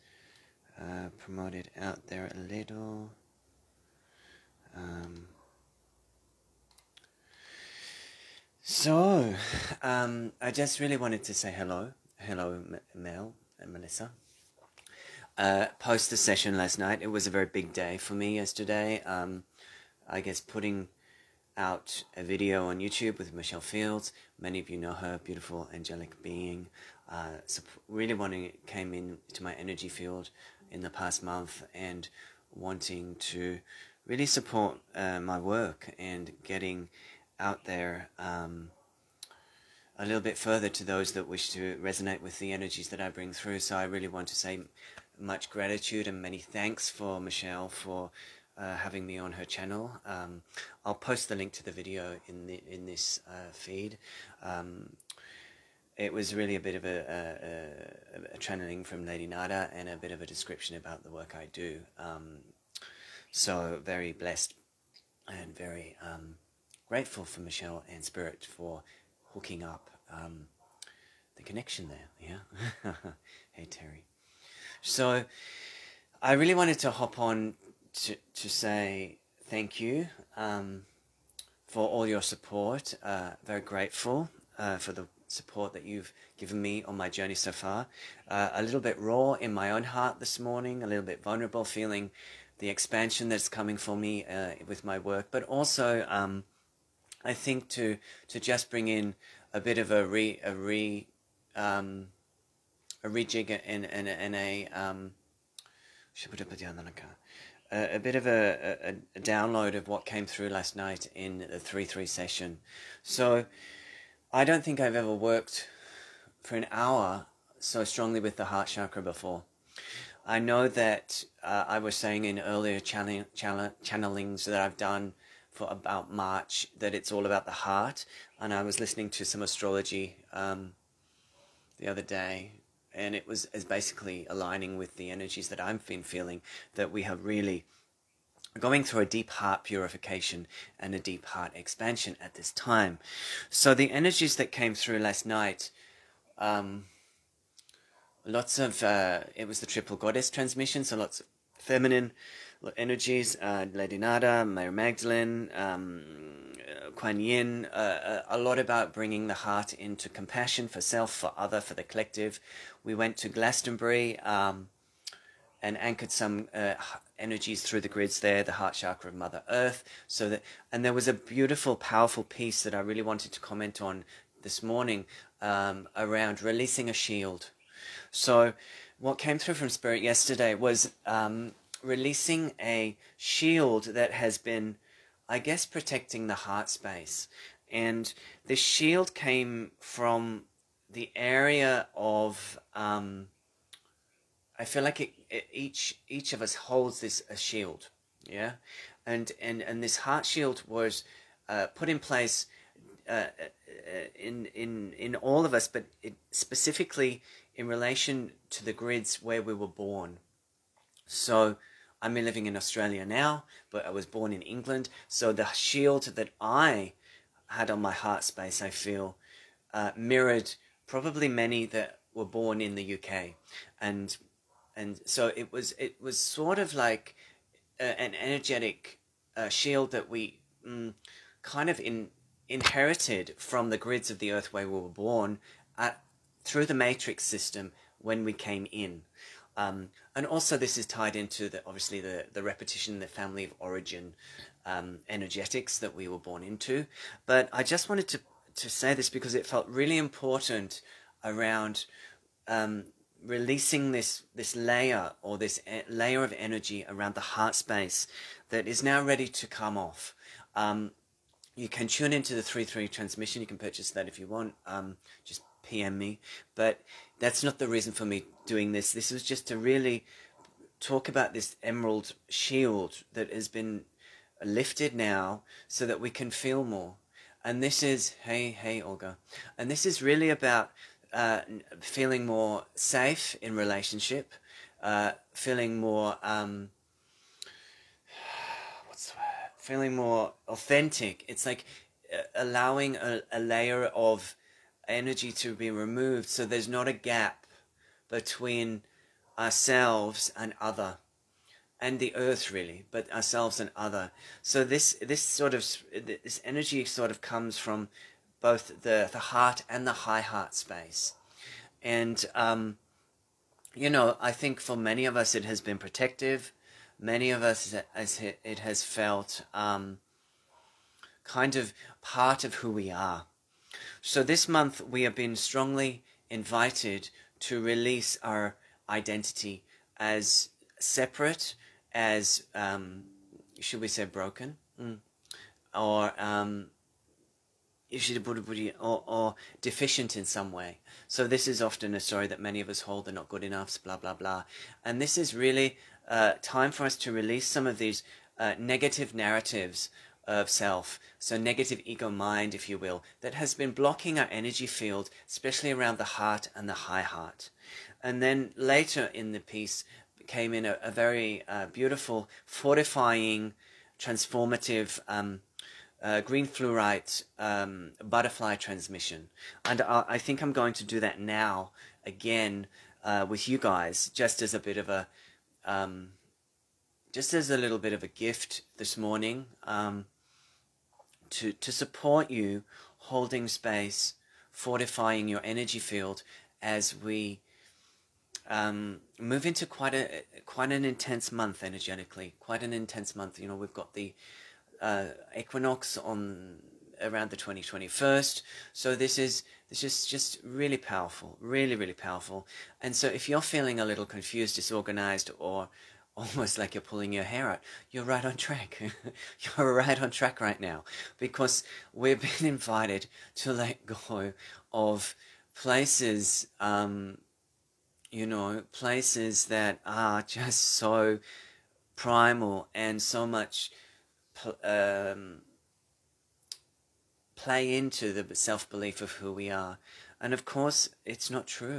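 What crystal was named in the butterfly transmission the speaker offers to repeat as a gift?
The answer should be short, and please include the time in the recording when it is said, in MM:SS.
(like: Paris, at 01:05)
green fluorite, at 06:06.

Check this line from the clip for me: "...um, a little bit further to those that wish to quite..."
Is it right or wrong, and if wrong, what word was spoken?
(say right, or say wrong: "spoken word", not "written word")
wrong: "resonate", not "quite".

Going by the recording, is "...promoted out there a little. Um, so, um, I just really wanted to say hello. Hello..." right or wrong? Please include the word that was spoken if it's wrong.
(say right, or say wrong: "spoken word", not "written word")
right.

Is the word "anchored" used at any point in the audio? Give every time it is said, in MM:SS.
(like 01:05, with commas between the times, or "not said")
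02:45.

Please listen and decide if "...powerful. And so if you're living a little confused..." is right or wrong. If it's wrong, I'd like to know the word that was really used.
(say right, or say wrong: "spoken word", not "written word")
wrong: "feeling", not "living".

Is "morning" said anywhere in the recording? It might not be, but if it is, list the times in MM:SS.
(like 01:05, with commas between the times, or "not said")
01:30, 02:54, 06:18.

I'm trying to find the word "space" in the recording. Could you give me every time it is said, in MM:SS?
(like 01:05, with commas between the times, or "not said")
03:06, 03:38, 04:17, 05:10, 06:23.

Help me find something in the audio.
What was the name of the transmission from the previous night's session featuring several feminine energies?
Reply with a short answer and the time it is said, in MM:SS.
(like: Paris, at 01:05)
triple goddess transmission, at 02:29.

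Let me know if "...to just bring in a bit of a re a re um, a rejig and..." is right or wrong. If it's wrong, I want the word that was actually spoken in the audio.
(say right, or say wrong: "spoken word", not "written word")
right.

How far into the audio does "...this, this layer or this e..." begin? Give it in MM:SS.
04:13.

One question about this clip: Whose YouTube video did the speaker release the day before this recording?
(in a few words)
Michelle Fields.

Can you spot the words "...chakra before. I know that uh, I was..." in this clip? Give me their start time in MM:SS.
01:58.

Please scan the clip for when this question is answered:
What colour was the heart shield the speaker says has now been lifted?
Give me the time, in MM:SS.
04:31.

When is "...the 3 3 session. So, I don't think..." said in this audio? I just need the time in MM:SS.
01:51.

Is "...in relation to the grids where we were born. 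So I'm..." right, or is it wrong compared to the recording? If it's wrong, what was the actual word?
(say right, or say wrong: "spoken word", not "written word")
right.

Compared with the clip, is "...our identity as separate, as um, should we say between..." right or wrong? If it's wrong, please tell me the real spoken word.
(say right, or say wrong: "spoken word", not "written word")
wrong: "broken", not "between".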